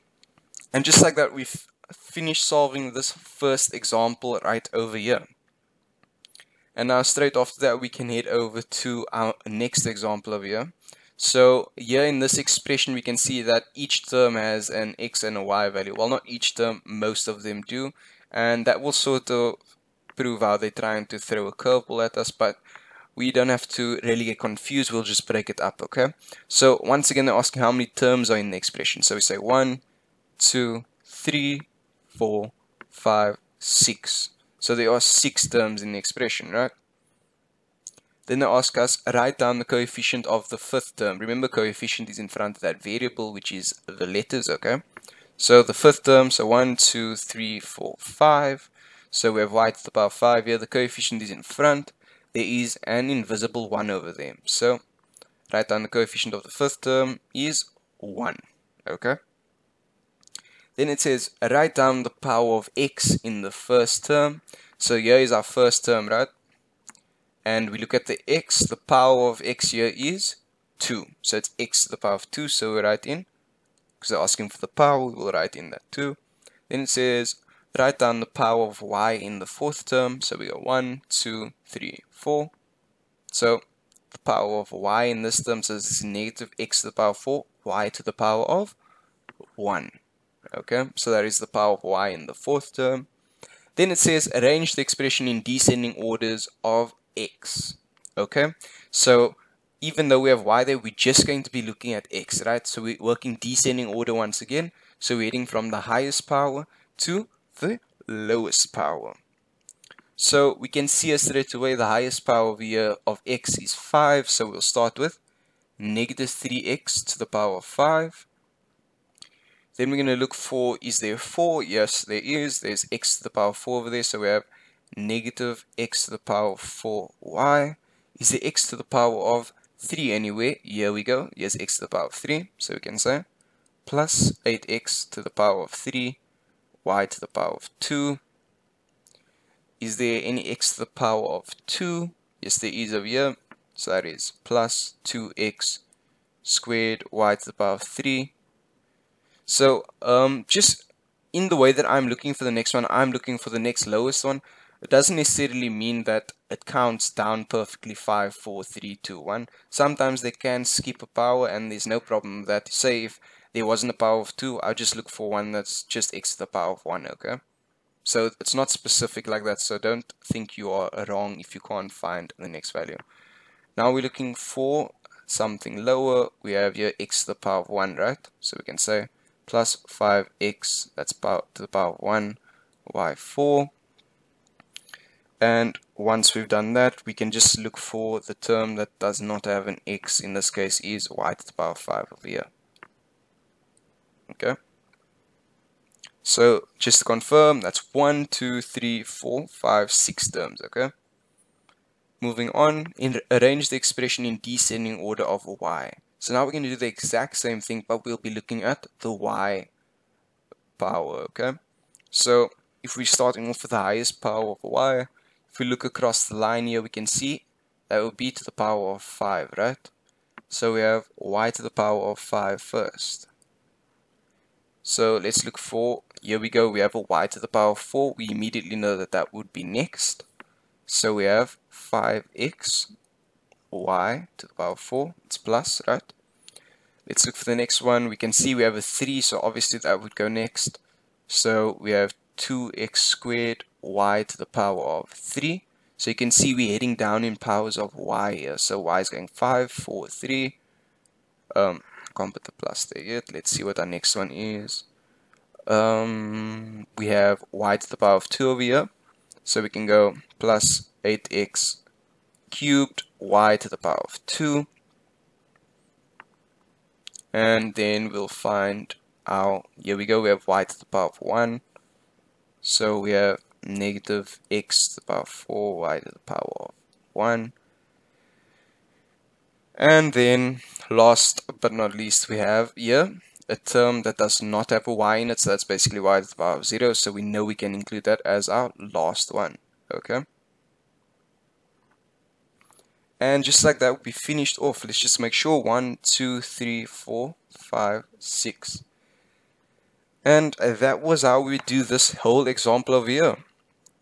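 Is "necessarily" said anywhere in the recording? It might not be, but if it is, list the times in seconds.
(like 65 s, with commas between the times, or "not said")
155 s.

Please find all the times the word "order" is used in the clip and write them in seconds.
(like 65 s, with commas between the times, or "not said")
95 s, 103 s, 204 s.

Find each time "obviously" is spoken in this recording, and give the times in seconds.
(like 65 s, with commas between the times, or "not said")
239 s.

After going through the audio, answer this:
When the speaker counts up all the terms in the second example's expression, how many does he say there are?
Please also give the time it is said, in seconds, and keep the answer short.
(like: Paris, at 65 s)
6, at 34 s.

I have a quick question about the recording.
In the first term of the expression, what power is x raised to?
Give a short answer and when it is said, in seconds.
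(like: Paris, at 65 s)
2, at 68 s.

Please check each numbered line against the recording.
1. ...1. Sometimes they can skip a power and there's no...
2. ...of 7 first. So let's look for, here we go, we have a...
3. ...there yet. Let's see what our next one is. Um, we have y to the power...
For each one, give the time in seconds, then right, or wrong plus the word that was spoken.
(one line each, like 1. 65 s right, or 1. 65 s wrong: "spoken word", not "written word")
1. 159 s right
2. 222 s wrong: "5", not "7"
3. 252 s right.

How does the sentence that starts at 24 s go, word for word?
We'll just break it up, okay?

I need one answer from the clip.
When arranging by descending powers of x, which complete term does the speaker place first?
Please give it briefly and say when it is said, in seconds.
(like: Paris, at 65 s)
-3x^5, at 115 s.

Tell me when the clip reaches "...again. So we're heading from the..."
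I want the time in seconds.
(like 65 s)
104 s.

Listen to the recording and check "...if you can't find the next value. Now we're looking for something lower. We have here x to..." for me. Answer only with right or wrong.
right.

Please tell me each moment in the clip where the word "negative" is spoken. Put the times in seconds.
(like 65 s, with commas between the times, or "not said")
86 s, 115 s, 124 s, 273 s.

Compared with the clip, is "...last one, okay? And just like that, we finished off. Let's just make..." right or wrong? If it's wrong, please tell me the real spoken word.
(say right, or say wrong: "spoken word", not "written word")
right.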